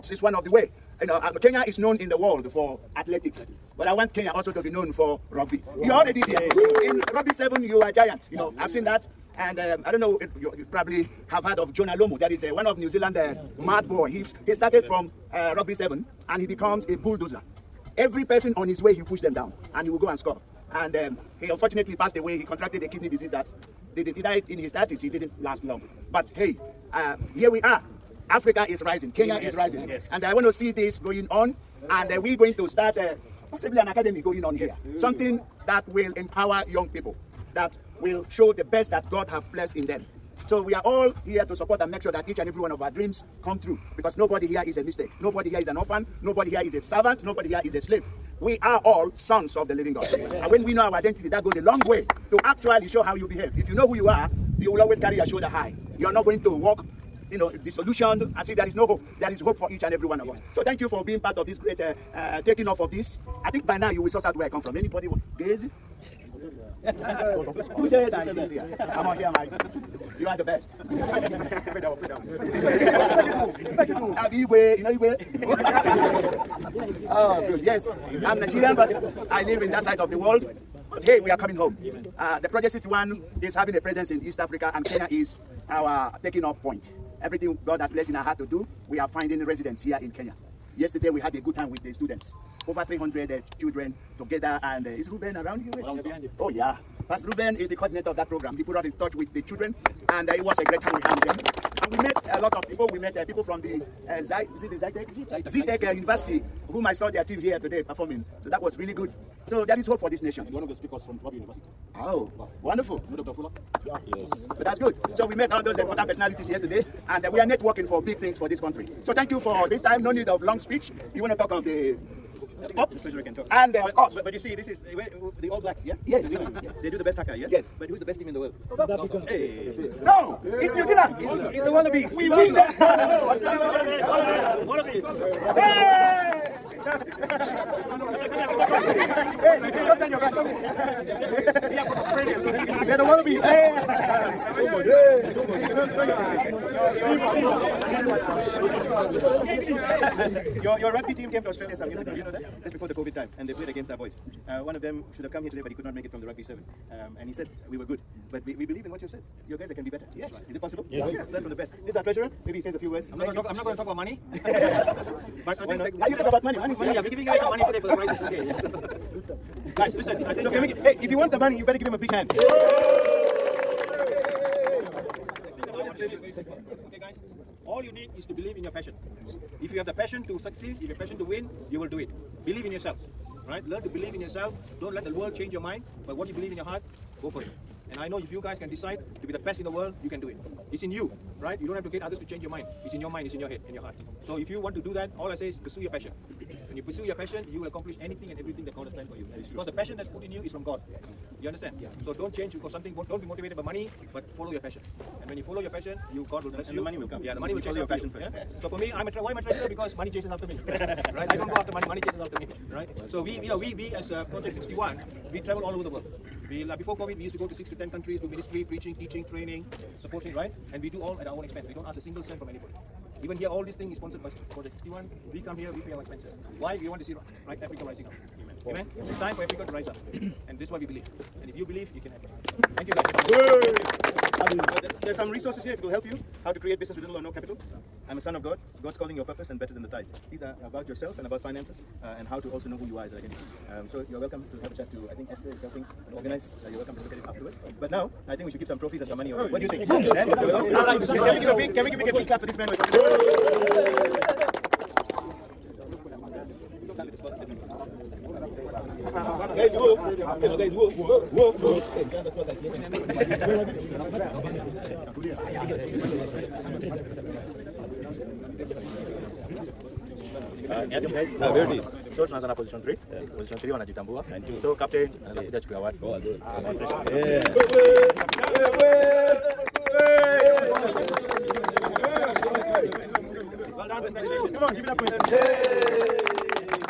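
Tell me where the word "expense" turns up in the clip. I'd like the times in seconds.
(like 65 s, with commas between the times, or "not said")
221 s, 226 s.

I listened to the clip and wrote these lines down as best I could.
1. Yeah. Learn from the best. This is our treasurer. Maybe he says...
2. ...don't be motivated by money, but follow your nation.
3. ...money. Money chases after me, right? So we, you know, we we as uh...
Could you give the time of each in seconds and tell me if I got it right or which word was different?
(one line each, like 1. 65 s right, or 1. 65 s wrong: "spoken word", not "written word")
1. 161 s right
2. 203 s wrong: "passion", not "nation"
3. 211 s right.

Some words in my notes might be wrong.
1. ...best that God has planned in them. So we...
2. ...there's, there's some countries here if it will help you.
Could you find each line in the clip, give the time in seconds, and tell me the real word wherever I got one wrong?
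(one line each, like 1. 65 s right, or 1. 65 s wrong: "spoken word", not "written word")
1. 38 s wrong: "blessed", not "planned"
2. 234 s wrong: "resources", not "countries".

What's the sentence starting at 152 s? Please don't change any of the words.
Just before the COVID time, and they played against our boys.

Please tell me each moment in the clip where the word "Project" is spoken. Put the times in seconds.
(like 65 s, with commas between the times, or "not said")
82 s, 214 s, 224 s.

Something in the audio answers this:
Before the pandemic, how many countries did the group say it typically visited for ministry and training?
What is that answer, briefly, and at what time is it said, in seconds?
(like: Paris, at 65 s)
6 to 10, at 217 s.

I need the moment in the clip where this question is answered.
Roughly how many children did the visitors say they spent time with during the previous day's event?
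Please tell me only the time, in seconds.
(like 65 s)
92 s.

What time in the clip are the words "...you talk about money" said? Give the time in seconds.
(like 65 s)
166 s.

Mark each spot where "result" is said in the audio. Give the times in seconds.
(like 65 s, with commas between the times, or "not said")
not said.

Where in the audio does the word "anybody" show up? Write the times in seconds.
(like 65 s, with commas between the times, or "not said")
64 s, 222 s.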